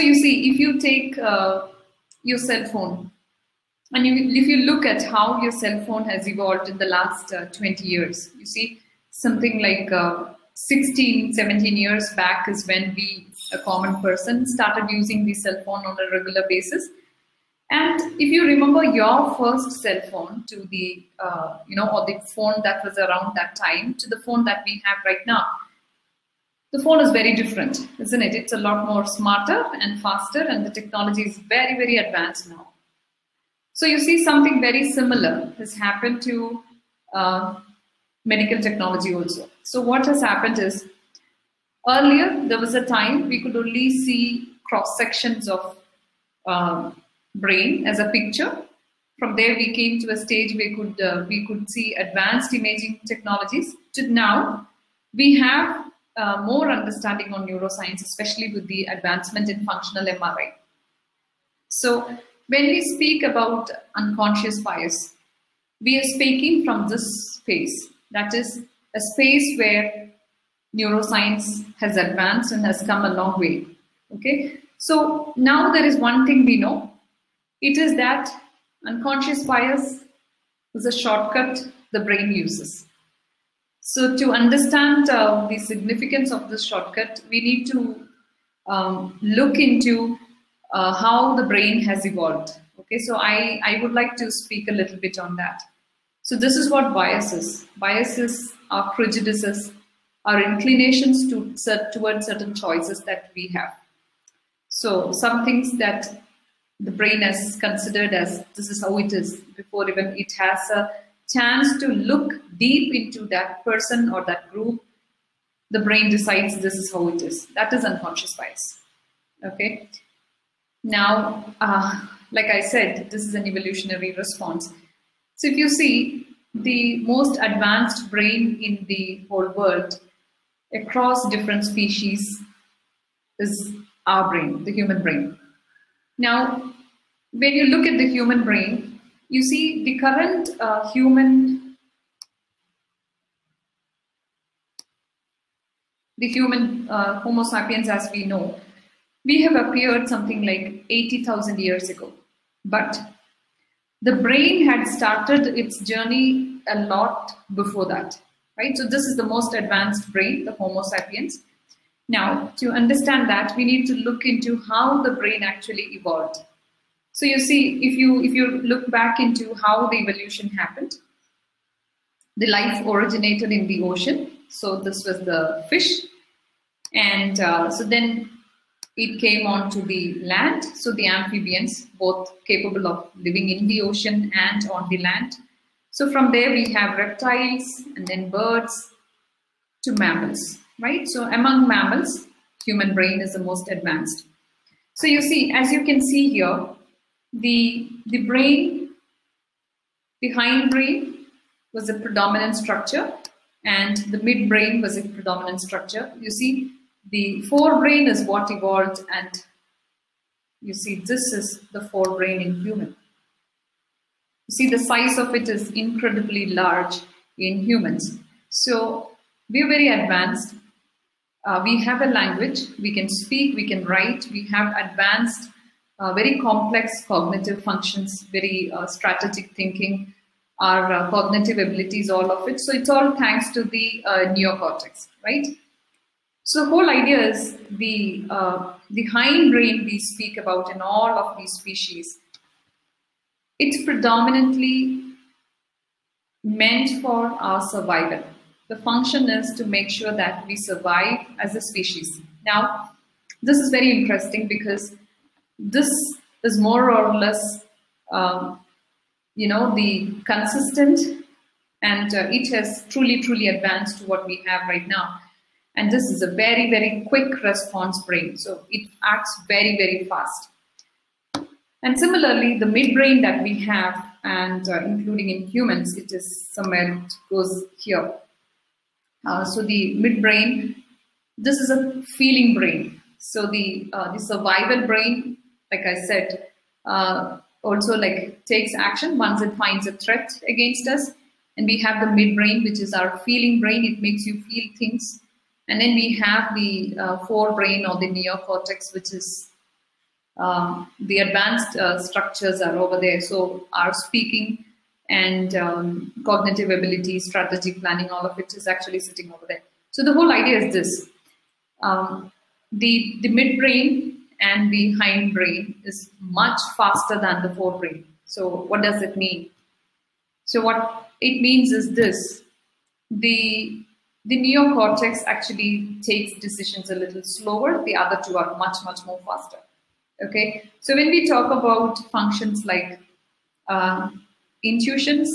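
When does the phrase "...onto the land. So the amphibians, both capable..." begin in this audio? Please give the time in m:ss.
2:59.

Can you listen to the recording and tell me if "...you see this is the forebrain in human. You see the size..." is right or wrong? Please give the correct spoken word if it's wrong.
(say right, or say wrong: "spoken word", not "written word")
right.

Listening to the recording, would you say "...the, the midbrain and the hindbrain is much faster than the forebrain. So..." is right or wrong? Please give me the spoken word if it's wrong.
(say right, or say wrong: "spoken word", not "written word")
right.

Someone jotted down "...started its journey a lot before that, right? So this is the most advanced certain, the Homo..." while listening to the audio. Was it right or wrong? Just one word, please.
wrong.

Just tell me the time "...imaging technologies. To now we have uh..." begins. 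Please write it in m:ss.
0:52.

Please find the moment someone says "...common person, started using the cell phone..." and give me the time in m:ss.
0:13.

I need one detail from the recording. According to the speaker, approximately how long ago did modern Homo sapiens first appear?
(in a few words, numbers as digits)
80,000 years ago.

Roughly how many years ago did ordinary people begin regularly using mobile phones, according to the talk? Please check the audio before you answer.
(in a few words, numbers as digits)
16, 17 years.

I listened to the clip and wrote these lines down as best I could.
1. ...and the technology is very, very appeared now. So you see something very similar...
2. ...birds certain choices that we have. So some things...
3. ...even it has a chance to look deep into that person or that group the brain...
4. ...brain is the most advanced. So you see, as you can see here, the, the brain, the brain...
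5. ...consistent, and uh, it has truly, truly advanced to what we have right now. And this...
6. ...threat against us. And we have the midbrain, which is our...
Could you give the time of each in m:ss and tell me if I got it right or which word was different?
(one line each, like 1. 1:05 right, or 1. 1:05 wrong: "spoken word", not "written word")
1. 0:30 wrong: "advanced", not "appeared"
2. 1:41 wrong: "towards", not "birds"
3. 1:49 right
4. 3:12 wrong: "hindbrain", not "brain"
5. 4:20 right
6. 4:49 right.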